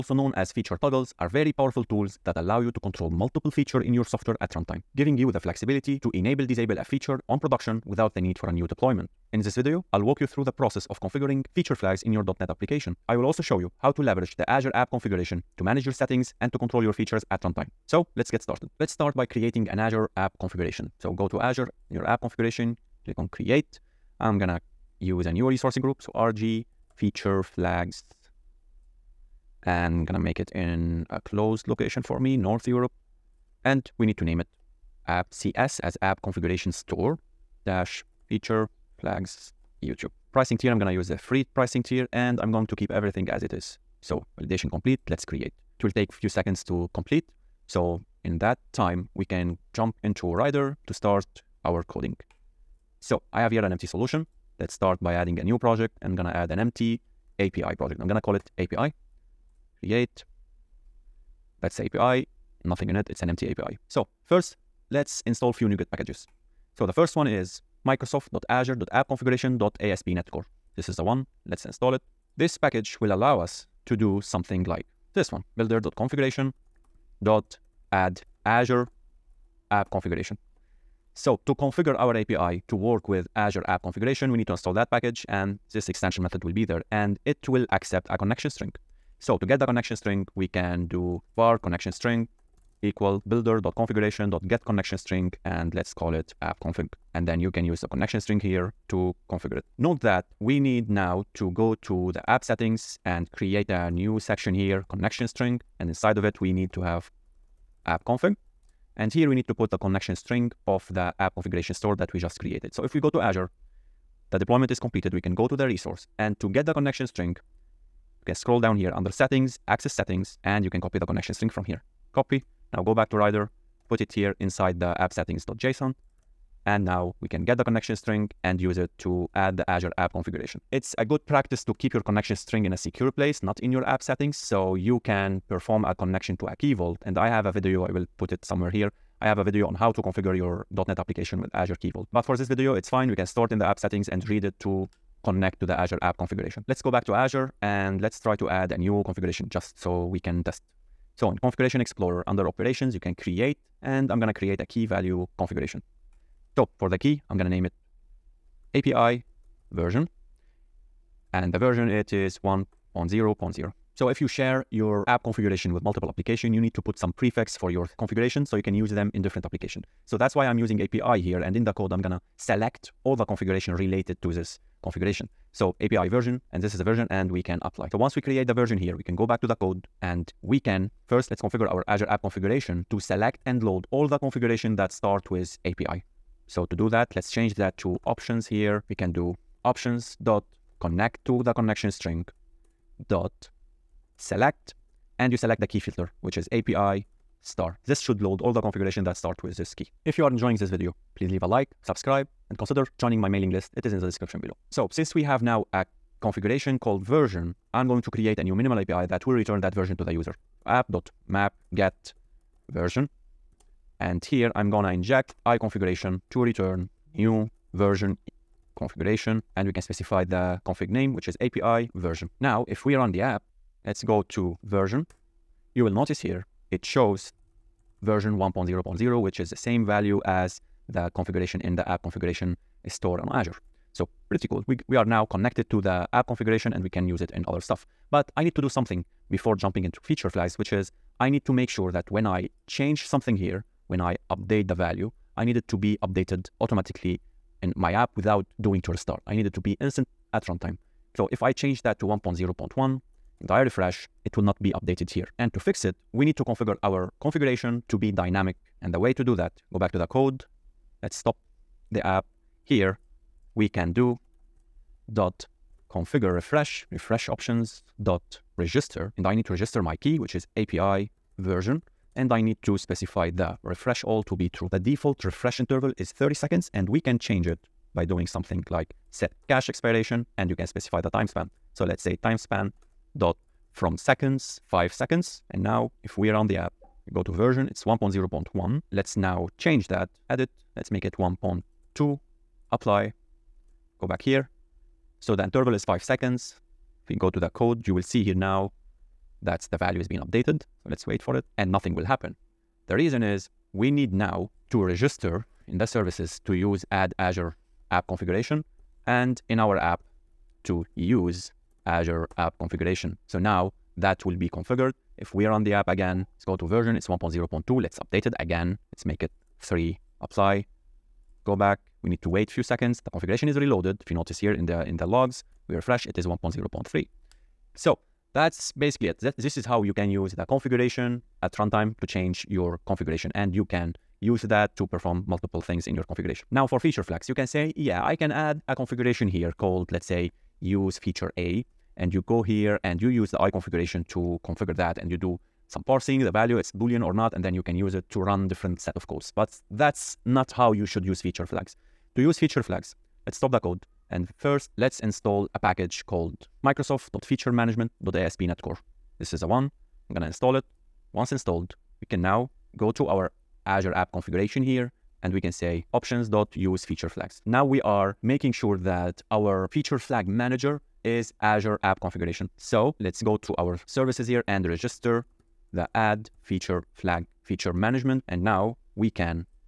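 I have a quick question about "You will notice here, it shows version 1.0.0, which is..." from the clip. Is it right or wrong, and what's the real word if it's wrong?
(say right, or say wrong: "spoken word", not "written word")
right.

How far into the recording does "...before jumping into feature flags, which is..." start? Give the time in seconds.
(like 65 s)
239 s.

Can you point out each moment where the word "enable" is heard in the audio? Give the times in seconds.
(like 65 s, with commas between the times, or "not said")
6 s.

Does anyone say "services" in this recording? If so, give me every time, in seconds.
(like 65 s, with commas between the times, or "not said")
305 s, 373 s.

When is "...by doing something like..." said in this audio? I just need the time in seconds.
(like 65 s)
277 s.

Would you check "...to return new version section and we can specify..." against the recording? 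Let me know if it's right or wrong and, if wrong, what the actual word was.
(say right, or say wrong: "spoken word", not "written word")
wrong: "configuration", not "section".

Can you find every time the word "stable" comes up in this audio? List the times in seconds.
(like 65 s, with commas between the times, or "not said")
not said.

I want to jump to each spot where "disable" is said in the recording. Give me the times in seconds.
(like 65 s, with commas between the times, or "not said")
6 s.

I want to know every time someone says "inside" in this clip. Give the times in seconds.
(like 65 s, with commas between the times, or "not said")
105 s, 124 s.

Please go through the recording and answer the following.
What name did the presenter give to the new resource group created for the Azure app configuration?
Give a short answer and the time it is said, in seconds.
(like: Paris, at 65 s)
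RG feature flags, at 26 s.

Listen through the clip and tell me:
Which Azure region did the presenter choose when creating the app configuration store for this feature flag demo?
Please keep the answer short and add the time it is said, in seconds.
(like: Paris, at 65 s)
North Europe, at 32 s.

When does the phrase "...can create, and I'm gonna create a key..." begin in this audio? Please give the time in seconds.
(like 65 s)
152 s.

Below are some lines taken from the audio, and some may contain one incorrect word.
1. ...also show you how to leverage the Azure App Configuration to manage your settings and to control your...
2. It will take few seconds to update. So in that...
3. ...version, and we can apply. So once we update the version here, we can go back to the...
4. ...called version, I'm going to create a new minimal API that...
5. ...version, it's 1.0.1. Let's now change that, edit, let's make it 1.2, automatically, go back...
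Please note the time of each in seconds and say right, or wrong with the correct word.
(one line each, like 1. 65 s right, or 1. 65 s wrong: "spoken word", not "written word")
1. 13 s right
2. 45 s wrong: "complete", not "update"
3. 176 s wrong: "create", not "update"
4. 206 s right
5. 287 s wrong: "apply", not "automatically".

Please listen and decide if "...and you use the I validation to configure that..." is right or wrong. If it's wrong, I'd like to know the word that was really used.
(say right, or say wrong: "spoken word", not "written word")
wrong: "configuration", not "validation".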